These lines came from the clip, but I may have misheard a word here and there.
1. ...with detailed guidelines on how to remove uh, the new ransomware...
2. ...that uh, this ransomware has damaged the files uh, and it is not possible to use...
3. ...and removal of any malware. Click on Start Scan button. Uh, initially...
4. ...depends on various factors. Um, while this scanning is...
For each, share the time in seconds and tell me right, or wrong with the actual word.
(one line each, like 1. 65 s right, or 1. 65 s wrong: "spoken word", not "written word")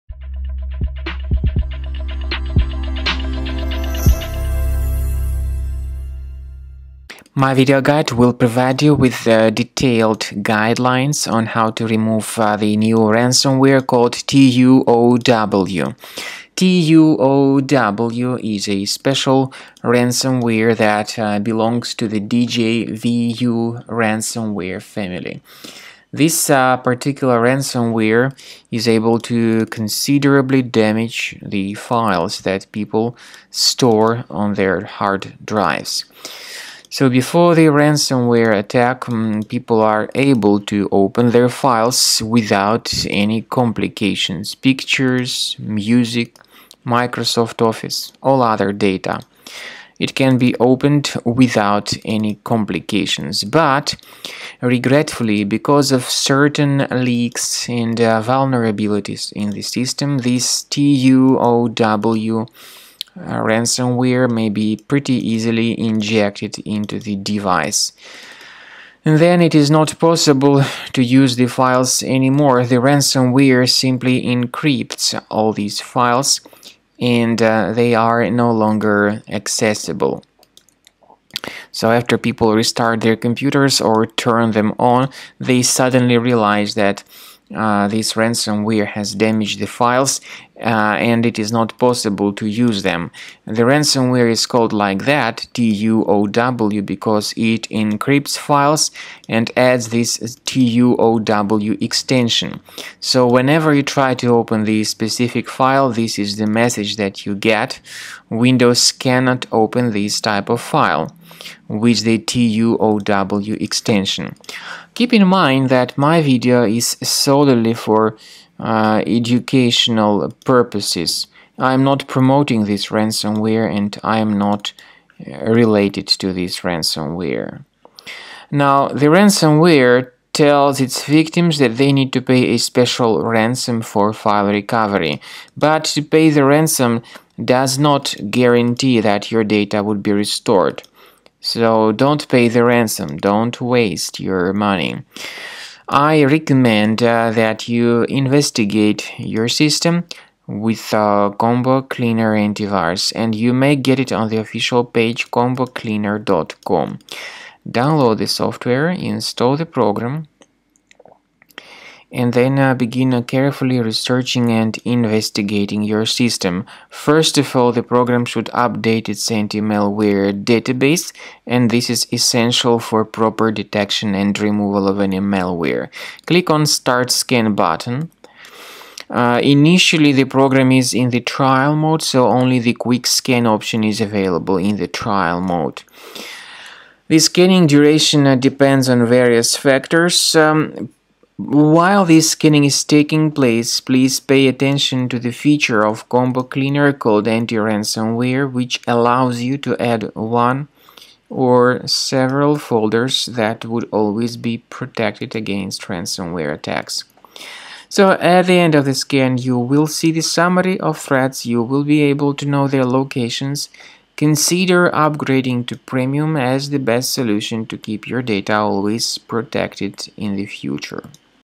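1. 8 s right
2. 86 s right
3. 174 s right
4. 188 s right.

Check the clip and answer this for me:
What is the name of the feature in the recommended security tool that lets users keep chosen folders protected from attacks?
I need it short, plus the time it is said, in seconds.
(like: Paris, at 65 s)
Anti-Ransomware, at 197 s.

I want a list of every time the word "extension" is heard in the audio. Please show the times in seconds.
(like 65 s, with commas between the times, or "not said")
101 s, 113 s.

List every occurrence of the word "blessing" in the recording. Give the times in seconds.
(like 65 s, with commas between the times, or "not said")
not said.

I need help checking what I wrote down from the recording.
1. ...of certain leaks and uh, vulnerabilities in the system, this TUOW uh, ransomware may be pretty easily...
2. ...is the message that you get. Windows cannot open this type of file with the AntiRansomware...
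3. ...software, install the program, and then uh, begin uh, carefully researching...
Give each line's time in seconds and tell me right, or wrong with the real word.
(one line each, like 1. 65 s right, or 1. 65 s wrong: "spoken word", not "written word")
1. 55 s right
2. 106 s wrong: "TUOW", not "AntiRansomware"
3. 158 s right.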